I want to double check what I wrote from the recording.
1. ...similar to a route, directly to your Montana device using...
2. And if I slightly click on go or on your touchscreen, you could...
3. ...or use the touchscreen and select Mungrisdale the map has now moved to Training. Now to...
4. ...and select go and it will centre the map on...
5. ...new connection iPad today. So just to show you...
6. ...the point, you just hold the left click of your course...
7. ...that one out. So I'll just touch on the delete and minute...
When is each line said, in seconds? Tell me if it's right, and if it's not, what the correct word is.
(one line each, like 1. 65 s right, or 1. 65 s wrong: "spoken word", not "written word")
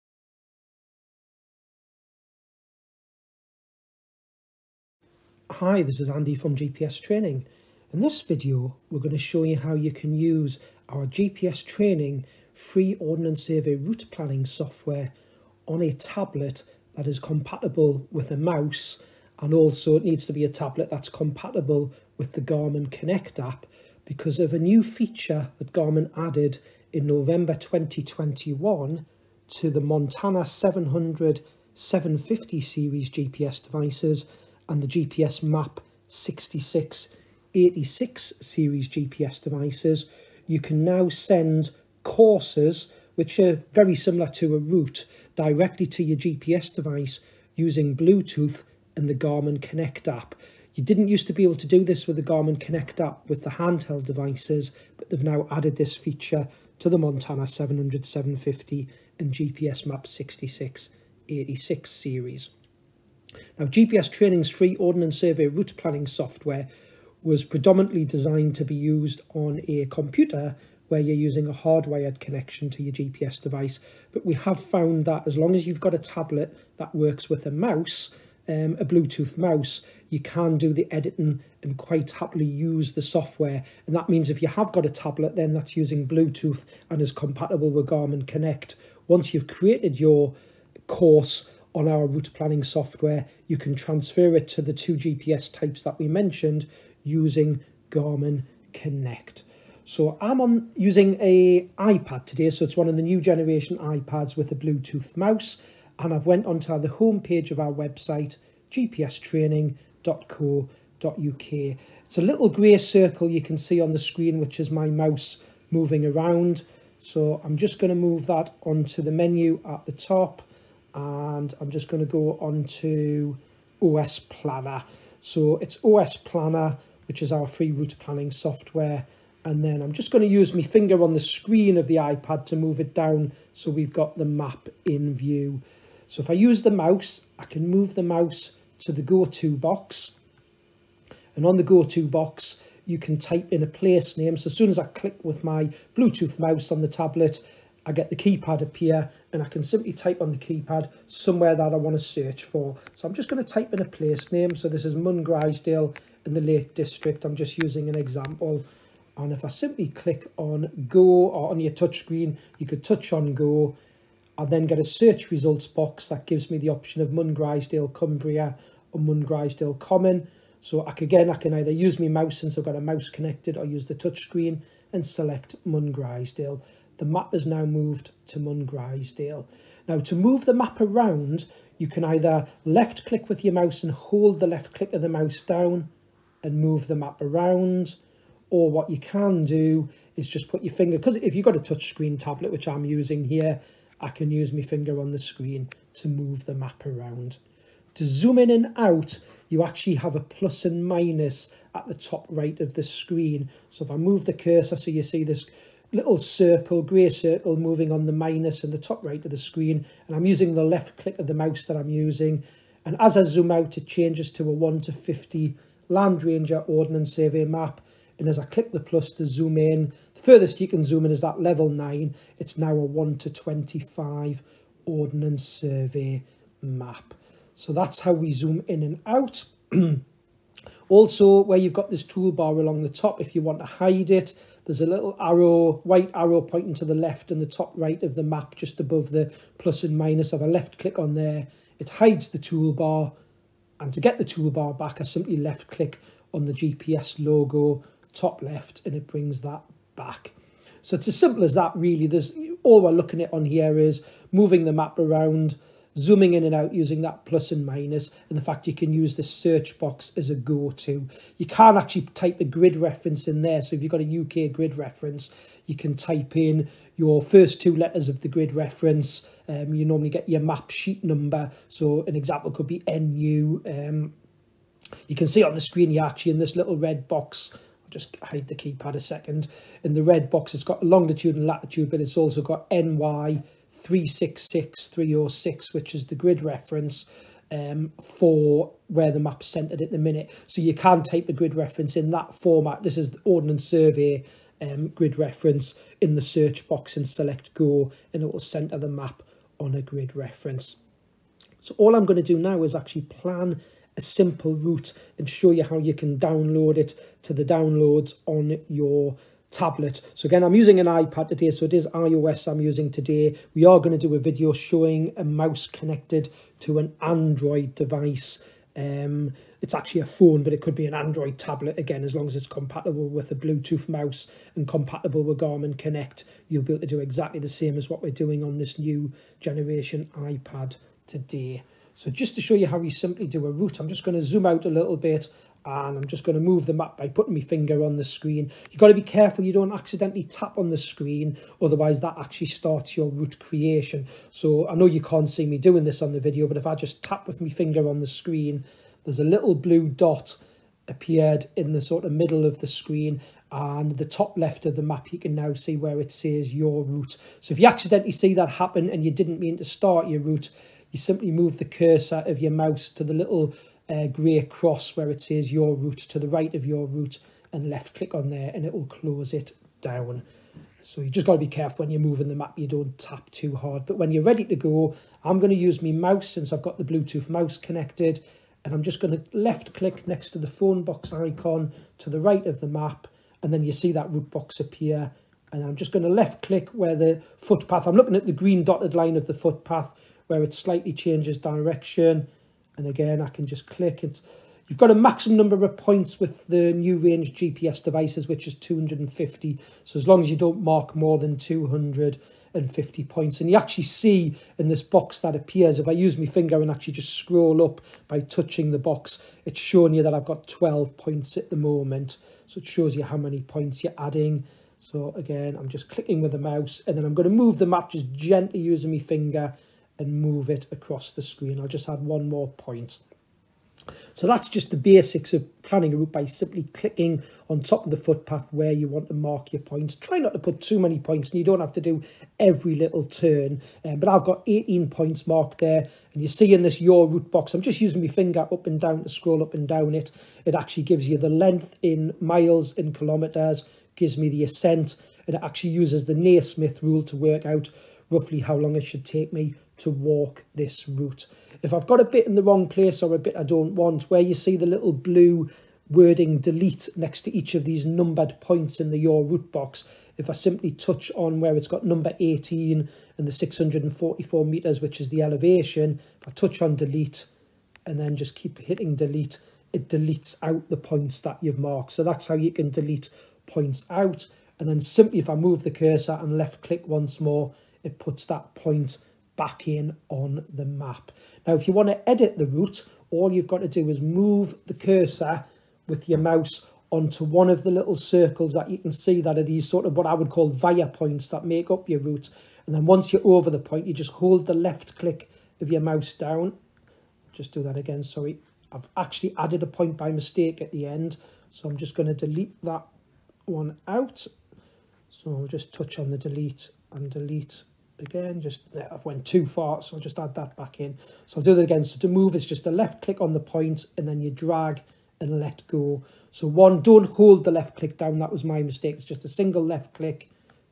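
1. 43 s wrong: "GPS", not "Montana"
2. 159 s wrong: "simply", not "slightly"
3. 173 s wrong: "Deal", not "Training"
4. 296 s right
5. 328 s wrong: "generation", not "connection"
6. 493 s wrong: "mouse", not "course"
7. 502 s wrong: "delete", not "minute".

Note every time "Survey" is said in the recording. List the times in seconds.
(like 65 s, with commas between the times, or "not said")
13 s, 65 s, 217 s, 225 s, 293 s.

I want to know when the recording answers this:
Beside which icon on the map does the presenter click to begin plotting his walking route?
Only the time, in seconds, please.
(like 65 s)
380 s.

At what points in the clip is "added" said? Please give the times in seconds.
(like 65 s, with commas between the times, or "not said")
26 s, 55 s, 499 s.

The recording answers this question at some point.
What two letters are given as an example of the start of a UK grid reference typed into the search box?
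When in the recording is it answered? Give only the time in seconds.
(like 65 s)
272 s.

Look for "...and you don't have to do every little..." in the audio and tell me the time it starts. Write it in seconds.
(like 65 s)
431 s.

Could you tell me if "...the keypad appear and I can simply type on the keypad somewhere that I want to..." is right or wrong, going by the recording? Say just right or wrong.
right.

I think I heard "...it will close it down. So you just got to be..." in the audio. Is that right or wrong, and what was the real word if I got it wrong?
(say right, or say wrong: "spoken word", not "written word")
right.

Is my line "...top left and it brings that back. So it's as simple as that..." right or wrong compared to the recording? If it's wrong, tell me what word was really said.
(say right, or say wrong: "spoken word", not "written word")
right.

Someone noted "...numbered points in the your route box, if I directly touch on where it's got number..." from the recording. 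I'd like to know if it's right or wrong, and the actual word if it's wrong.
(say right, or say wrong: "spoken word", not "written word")
wrong: "simply", not "directly".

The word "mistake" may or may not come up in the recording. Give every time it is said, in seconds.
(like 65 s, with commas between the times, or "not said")
500 s, 518 s.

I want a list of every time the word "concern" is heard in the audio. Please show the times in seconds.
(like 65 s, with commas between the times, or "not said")
not said.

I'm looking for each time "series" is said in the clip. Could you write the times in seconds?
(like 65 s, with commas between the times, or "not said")
32 s, 38 s, 61 s.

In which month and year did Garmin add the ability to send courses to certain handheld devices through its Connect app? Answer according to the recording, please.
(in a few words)
November 2021.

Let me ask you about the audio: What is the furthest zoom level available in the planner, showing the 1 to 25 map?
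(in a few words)
level 9.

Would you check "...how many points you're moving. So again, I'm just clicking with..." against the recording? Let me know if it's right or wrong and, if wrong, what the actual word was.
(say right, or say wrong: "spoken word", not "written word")
wrong: "adding", not "moving".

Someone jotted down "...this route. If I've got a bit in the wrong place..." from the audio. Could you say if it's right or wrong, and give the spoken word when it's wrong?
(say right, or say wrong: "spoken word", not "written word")
right.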